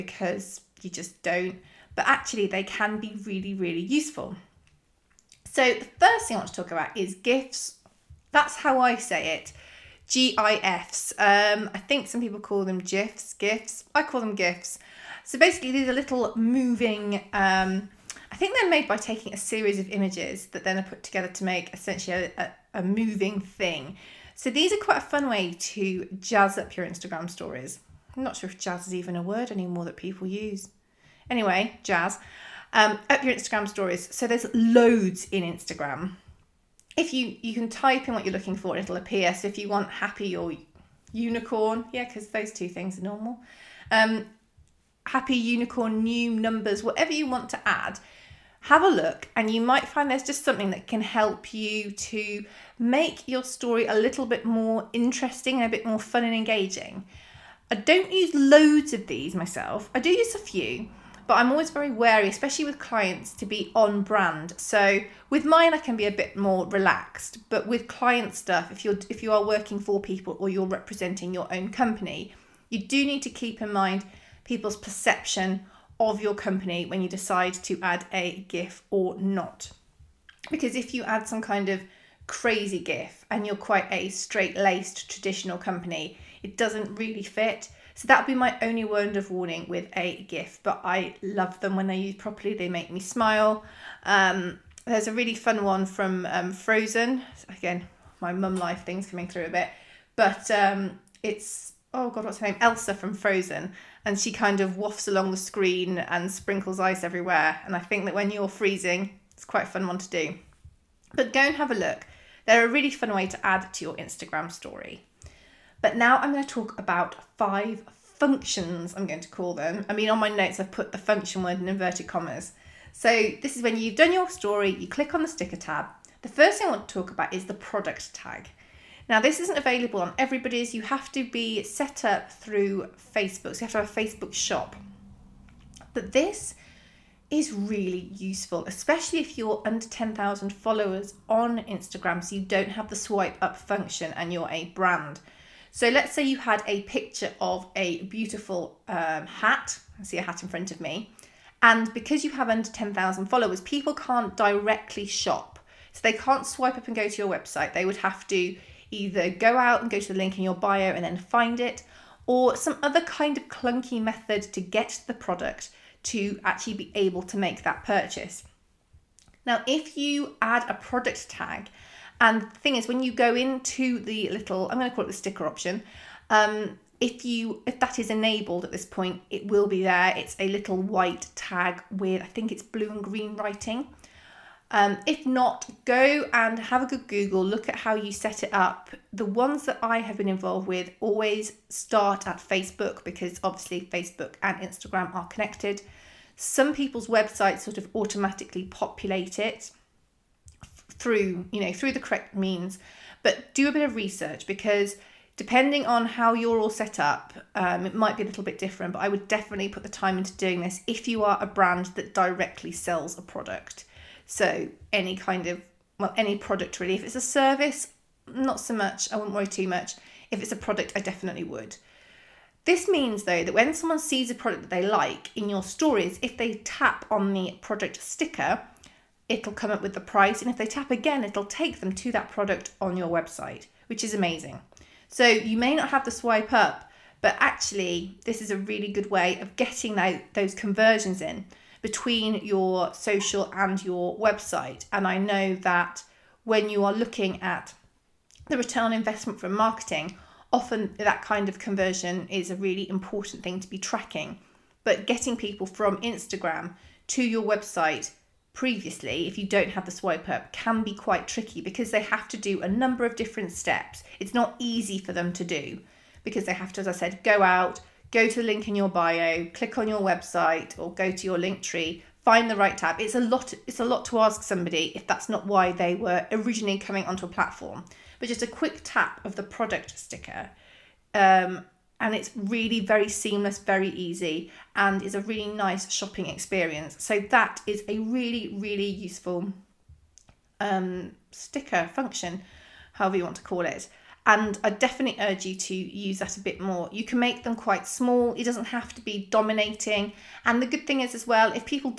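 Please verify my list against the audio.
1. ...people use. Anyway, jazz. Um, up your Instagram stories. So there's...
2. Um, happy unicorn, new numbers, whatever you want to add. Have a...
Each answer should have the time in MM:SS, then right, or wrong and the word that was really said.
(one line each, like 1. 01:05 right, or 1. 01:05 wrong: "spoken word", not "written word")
1. 00:29 right
2. 00:43 right.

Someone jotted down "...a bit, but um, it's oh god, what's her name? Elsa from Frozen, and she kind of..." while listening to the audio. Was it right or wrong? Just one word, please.
right.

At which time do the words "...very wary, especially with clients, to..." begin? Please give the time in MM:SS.
01:01.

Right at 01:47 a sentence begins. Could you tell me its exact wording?
And I think that when you're freezing, it's quite a fun one to do.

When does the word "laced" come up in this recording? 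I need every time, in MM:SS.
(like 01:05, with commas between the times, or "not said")
01:24.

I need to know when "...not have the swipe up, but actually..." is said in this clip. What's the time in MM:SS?
03:55.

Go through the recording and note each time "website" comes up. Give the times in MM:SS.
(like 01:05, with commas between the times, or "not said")
02:37, 03:17, 03:53, 04:04, 04:17, 04:29.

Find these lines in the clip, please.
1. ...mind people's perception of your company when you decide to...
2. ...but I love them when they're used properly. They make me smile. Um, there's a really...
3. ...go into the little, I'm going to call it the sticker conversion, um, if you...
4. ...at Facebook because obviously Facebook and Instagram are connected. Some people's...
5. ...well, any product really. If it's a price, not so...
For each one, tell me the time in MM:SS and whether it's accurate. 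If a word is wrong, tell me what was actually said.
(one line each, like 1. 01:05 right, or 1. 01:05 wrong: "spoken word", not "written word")
1. 01:13 right
2. 01:30 right
3. 02:53 wrong: "option", not "conversion"
4. 03:12 right
5. 03:35 wrong: "service", not "price".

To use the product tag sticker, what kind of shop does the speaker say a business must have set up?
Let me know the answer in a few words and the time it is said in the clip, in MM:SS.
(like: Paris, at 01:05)
a Facebook shop, at 02:13.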